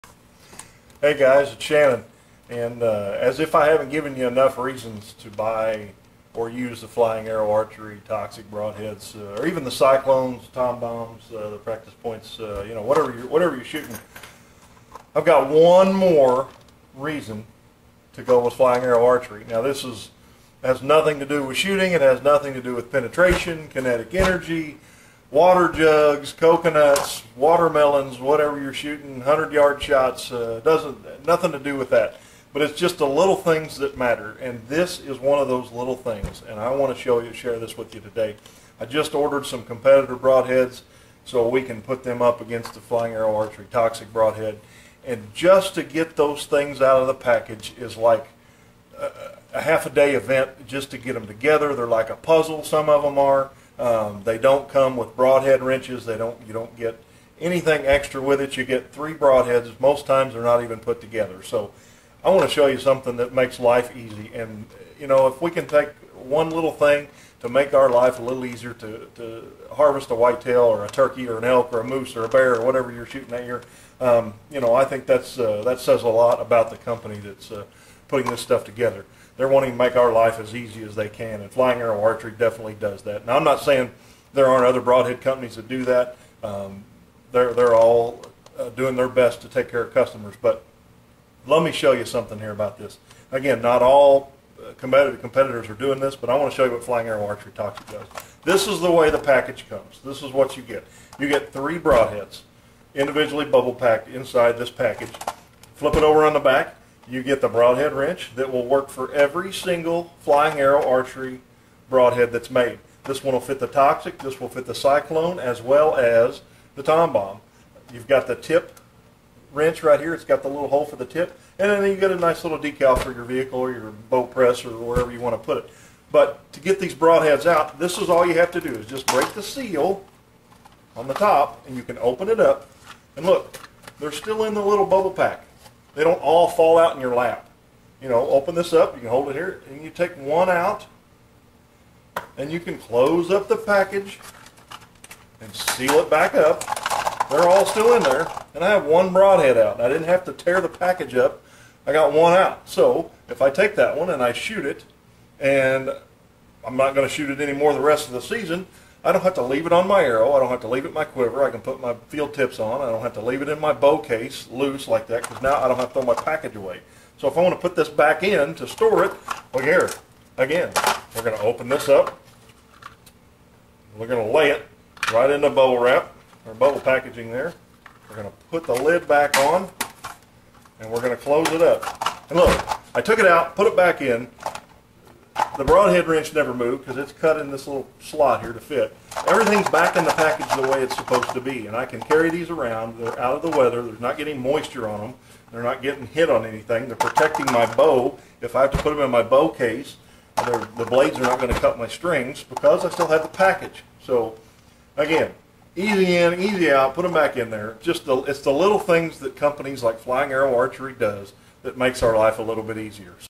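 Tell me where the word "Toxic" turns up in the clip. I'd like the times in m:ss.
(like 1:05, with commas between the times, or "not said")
0:08, 0:43, 1:37, 1:53.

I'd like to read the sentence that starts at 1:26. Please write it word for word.
Um, they're, they're all uh, doing their best to take care of customers, but let me show you something here about this.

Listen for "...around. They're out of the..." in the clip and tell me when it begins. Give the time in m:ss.
3:12.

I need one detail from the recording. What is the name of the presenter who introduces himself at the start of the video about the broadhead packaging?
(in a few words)
Shannon.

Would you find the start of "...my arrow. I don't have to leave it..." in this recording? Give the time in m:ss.
2:39.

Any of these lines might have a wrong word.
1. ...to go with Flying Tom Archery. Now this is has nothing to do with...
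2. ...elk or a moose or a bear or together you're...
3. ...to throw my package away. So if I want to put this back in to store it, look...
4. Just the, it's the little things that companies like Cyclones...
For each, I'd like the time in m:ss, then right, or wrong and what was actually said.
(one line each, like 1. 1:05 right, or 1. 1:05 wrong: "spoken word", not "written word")
1. 0:18 wrong: "Arrow", not "Tom"
2. 1:11 wrong: "whatever", not "together"
3. 2:45 right
4. 3:27 wrong: "Flying", not "Cyclones".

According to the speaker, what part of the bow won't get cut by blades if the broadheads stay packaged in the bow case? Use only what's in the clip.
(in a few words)
Strings.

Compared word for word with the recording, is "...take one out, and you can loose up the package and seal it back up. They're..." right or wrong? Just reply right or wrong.
wrong.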